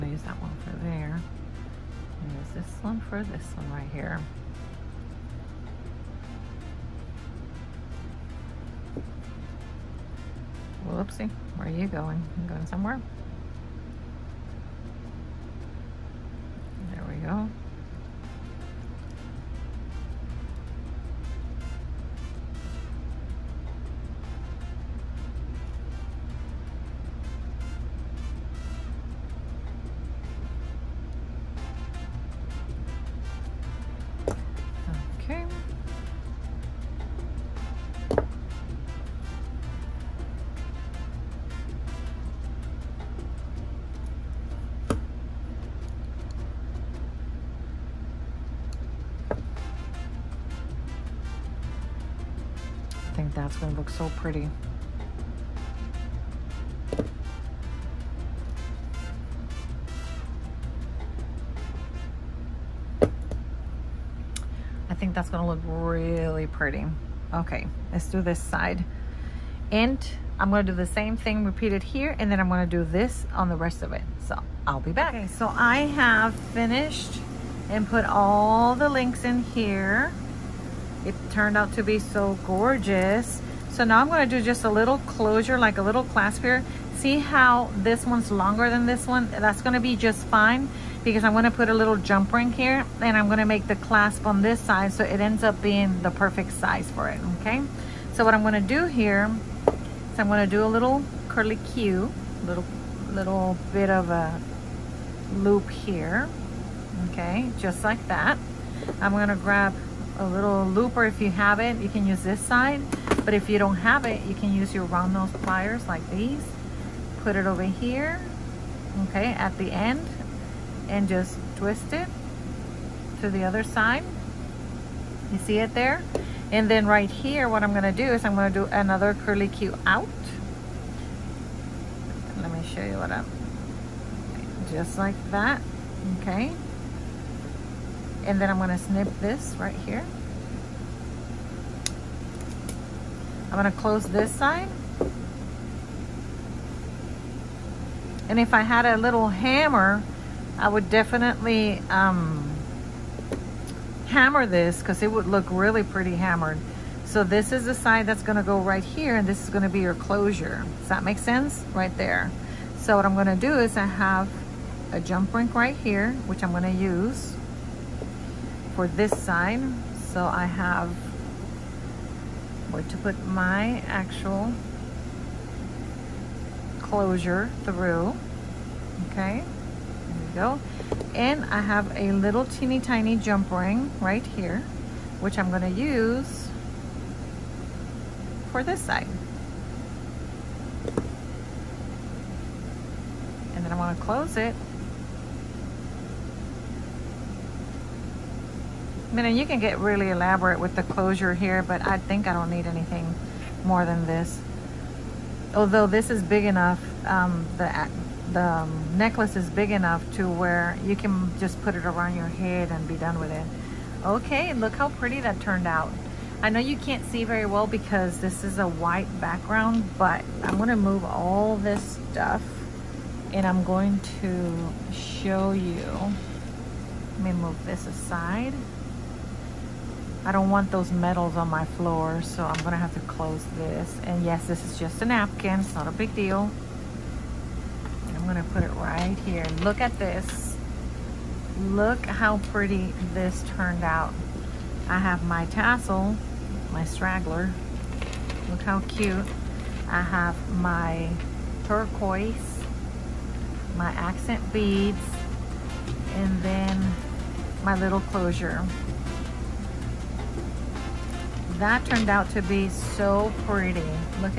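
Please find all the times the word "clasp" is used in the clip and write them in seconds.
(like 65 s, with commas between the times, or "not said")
86 s, 93 s.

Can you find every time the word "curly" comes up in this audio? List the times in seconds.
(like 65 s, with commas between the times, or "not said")
101 s, 129 s.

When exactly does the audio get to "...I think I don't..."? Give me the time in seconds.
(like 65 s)
201 s.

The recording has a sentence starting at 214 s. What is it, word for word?
Okay, look how pretty that turned out.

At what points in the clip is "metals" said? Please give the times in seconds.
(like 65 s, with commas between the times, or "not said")
230 s.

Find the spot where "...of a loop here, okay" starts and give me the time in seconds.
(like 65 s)
103 s.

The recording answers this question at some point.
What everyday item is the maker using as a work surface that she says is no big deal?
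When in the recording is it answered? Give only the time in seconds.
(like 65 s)
235 s.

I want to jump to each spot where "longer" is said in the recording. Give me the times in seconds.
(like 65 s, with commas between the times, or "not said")
88 s.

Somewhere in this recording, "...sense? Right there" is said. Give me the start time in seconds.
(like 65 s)
161 s.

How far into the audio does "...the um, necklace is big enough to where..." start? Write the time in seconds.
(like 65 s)
208 s.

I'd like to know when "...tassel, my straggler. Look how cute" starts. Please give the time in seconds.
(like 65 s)
245 s.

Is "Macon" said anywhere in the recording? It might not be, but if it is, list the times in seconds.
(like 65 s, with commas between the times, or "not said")
not said.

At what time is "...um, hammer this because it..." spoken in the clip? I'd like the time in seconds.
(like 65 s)
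151 s.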